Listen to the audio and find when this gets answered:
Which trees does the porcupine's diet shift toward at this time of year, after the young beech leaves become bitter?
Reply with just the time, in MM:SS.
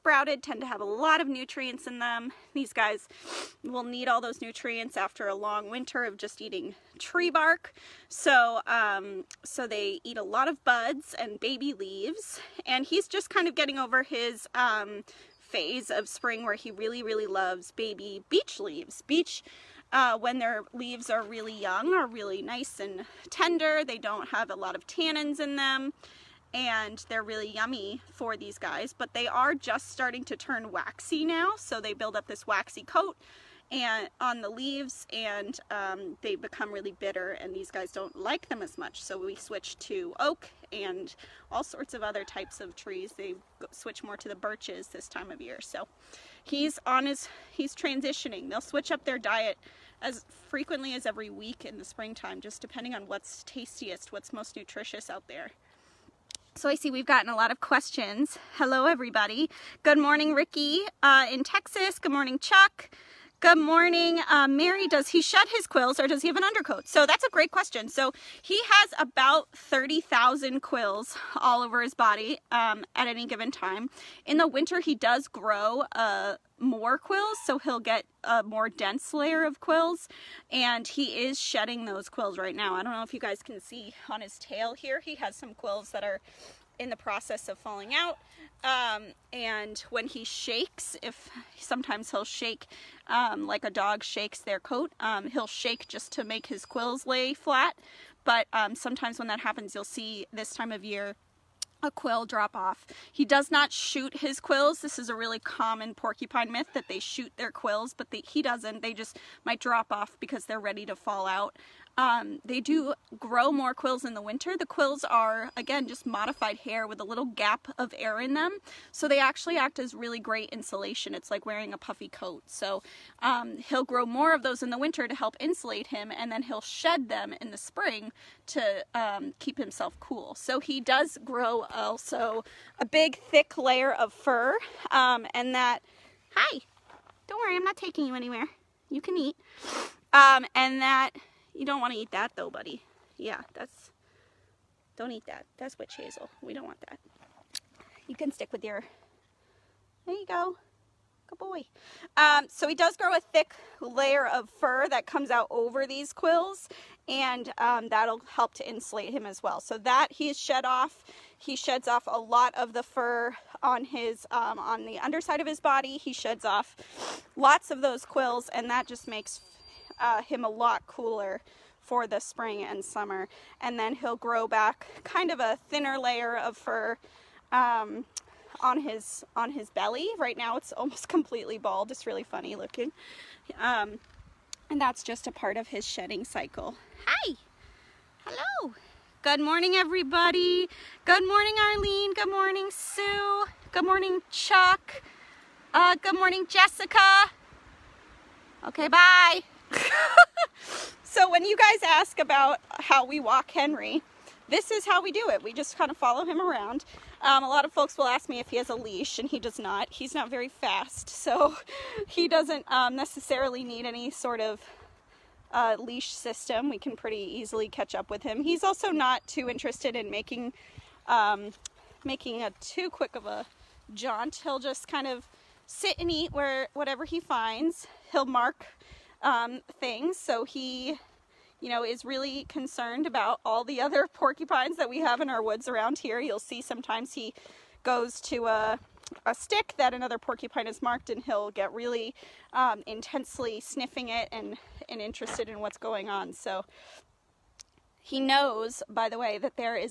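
00:44.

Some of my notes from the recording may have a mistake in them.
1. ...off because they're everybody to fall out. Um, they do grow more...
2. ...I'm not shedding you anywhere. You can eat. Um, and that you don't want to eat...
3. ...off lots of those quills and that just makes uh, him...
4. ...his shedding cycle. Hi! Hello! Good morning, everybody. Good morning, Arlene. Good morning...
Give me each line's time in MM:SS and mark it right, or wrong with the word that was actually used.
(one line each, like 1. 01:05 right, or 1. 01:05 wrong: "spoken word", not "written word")
1. 01:49 wrong: "ready", not "everybody"
2. 02:17 wrong: "taking", not "shedding"
3. 02:46 right
4. 03:05 right.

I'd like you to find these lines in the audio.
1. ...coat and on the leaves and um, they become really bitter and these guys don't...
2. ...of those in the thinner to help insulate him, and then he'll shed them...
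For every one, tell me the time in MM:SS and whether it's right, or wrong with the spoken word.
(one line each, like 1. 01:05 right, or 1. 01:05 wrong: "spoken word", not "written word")
1. 00:32 right
2. 02:04 wrong: "winter", not "thinner".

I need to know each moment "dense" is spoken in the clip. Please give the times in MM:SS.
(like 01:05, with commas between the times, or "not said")
01:18.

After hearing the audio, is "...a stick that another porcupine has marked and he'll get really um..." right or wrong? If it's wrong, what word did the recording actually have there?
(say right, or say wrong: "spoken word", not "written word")
right.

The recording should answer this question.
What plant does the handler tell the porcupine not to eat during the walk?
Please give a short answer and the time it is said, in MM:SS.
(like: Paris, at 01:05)
Witch hazel, at 02:25.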